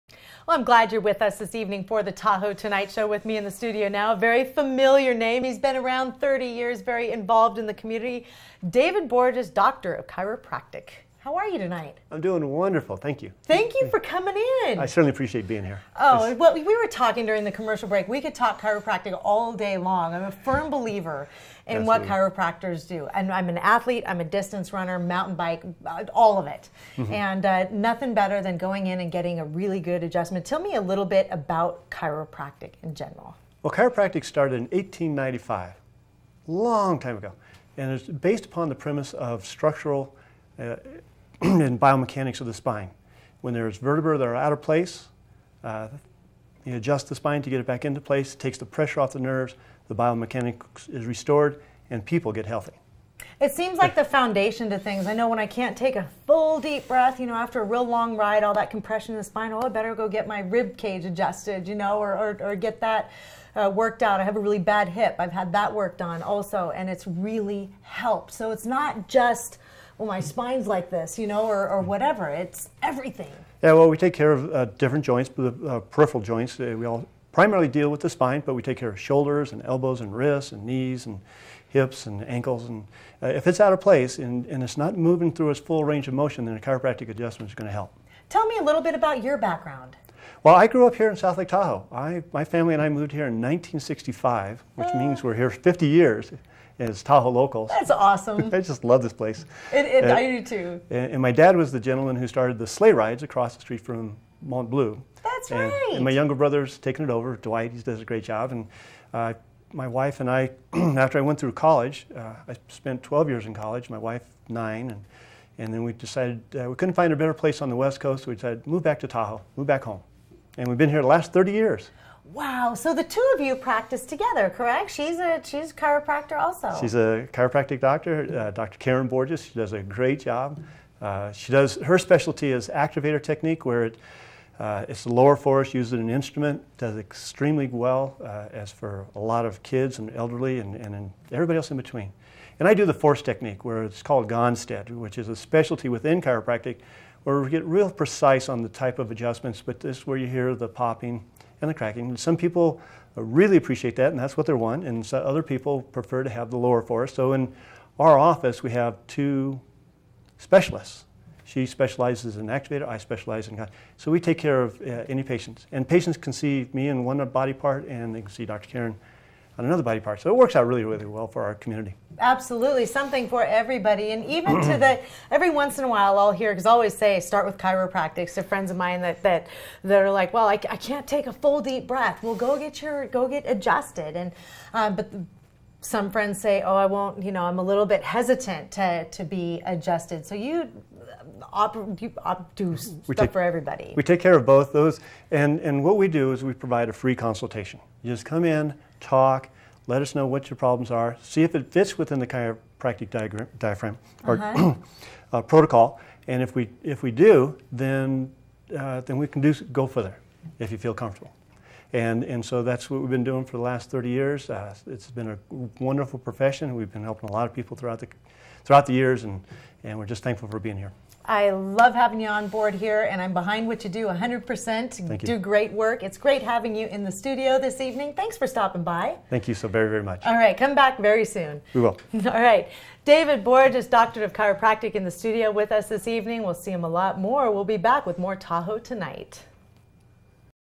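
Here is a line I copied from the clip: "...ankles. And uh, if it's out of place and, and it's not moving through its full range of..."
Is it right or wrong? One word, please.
right.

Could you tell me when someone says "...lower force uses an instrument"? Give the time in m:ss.
2:15.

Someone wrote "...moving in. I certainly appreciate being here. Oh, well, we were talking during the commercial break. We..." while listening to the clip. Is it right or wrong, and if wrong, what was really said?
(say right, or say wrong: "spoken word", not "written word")
wrong: "coming", not "moving".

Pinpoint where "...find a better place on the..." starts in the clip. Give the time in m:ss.
1:56.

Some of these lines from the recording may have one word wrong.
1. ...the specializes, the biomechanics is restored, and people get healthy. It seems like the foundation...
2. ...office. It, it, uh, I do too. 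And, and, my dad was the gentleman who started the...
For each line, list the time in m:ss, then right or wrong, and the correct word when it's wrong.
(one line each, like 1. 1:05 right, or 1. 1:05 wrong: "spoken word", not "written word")
1. 0:49 wrong: "nerves", not "specializes"
2. 1:39 wrong: "place", not "office".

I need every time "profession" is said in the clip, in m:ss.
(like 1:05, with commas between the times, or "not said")
3:36.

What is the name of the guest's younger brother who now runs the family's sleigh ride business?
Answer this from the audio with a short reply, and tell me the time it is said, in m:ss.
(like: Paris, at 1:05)
Dwight, at 1:47.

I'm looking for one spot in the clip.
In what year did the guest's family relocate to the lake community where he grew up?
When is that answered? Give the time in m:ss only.
1:33.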